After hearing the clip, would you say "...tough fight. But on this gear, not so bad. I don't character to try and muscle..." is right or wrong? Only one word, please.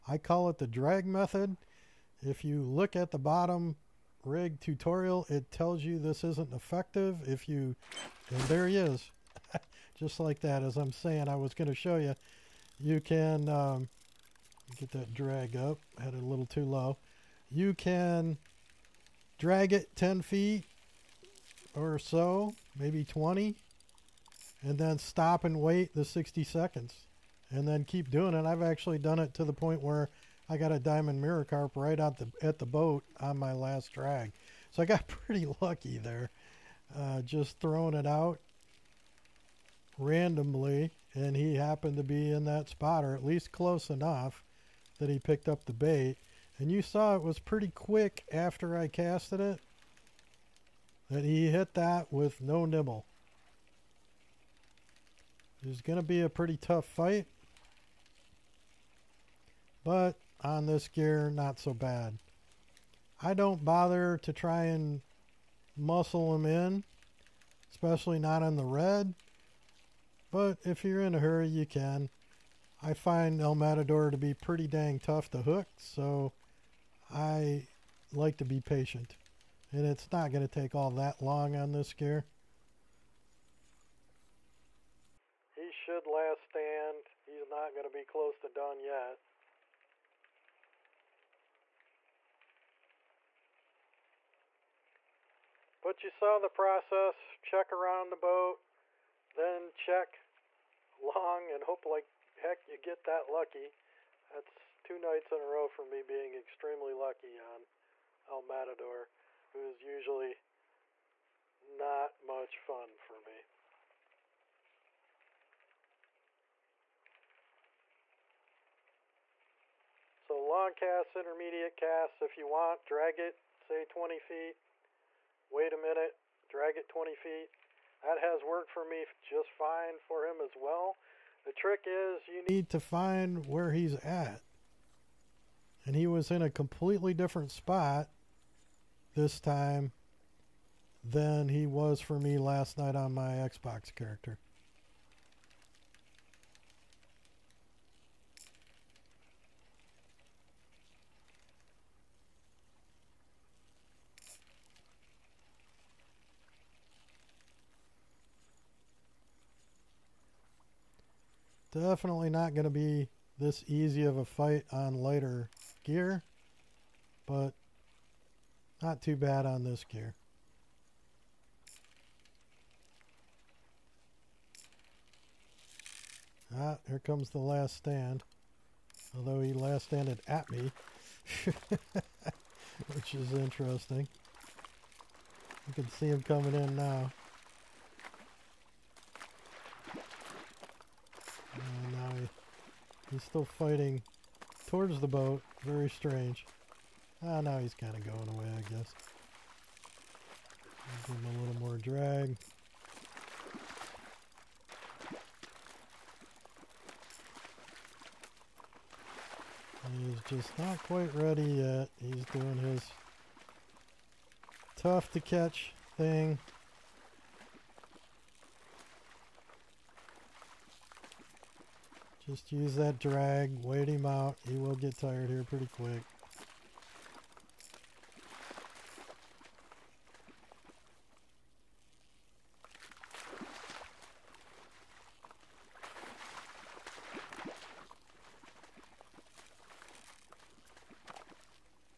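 wrong.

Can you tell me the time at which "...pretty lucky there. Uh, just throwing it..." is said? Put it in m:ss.
0:35.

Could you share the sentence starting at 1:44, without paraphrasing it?
That's two nights in a row for me being extremely lucky on El Matador, who is usually not much fun for me.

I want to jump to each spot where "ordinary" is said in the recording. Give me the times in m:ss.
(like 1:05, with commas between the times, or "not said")
not said.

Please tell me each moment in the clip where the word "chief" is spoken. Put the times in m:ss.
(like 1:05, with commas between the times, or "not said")
not said.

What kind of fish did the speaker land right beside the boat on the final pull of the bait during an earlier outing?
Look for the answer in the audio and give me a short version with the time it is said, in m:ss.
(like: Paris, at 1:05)
diamond mirror carp, at 0:30.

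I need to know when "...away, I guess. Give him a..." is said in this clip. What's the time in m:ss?
3:18.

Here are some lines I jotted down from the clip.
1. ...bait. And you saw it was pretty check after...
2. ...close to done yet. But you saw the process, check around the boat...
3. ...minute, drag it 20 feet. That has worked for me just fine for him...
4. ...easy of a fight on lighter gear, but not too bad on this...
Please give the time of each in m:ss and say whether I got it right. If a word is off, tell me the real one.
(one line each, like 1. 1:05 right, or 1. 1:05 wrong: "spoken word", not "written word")
1. 0:45 wrong: "quick", not "check"
2. 1:28 right
3. 2:05 right
4. 2:43 right.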